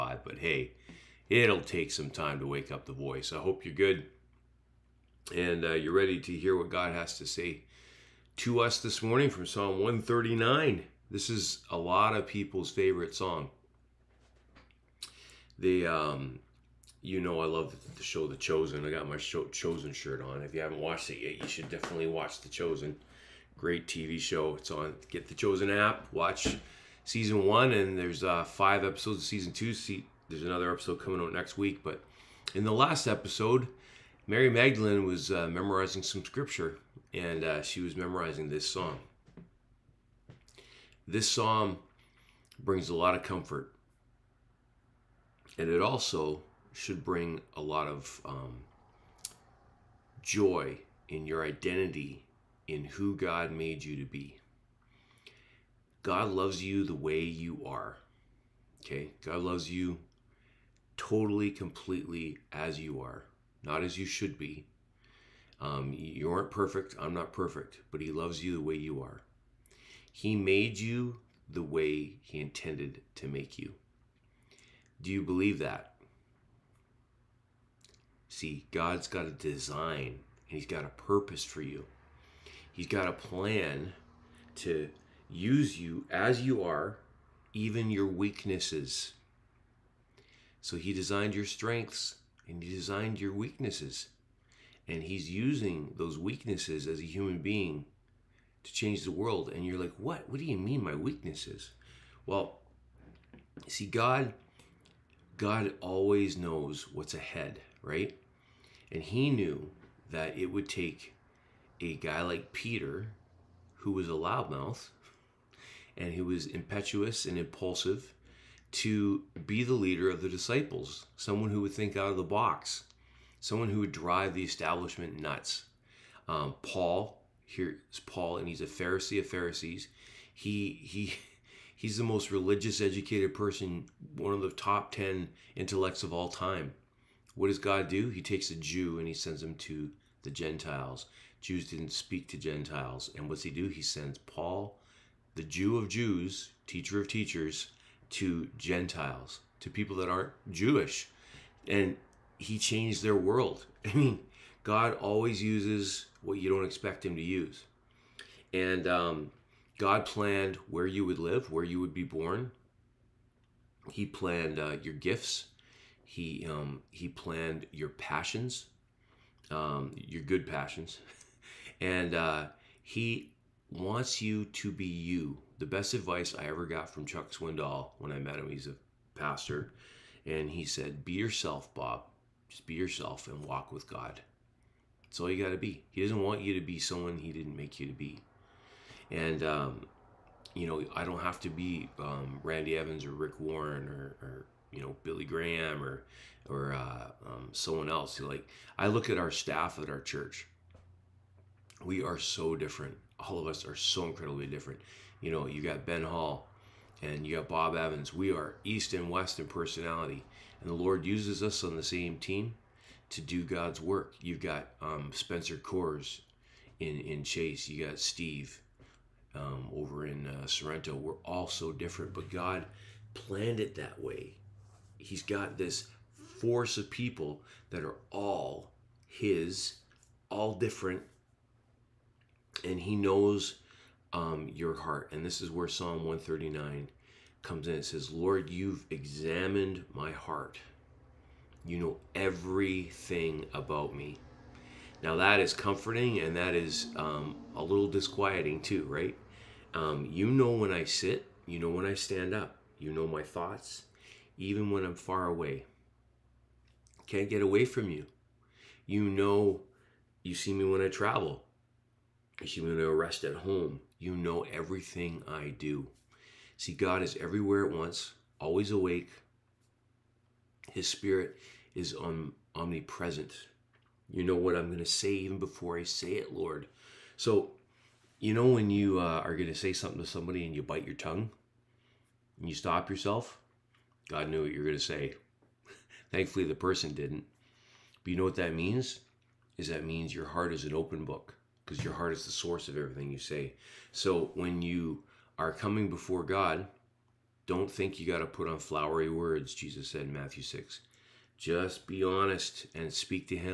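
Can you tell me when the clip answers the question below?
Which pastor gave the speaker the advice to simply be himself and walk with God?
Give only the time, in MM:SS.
02:57.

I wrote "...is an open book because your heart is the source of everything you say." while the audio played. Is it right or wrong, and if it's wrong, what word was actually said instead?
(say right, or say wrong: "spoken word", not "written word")
right.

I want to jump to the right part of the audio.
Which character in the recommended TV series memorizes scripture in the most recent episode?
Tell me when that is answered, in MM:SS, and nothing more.
00:34.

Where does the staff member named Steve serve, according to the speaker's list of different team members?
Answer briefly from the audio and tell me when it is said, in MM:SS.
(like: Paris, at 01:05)
Sorrento, at 03:40.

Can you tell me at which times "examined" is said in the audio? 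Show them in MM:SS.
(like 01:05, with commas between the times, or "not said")
03:58.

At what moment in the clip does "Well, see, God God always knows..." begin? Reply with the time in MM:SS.
01:42.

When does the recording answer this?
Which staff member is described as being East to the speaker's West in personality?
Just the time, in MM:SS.
03:25.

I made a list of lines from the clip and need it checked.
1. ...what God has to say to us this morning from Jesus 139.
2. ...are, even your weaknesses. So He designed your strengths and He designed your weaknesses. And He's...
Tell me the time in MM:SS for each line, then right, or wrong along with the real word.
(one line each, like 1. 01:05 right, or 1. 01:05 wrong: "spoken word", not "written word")
1. 00:06 wrong: "Psalm", not "Jesus"
2. 01:26 right.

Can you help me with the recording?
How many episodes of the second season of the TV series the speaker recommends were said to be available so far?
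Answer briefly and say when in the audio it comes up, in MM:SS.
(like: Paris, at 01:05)
5, at 00:28.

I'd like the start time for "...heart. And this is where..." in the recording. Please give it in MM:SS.
03:54.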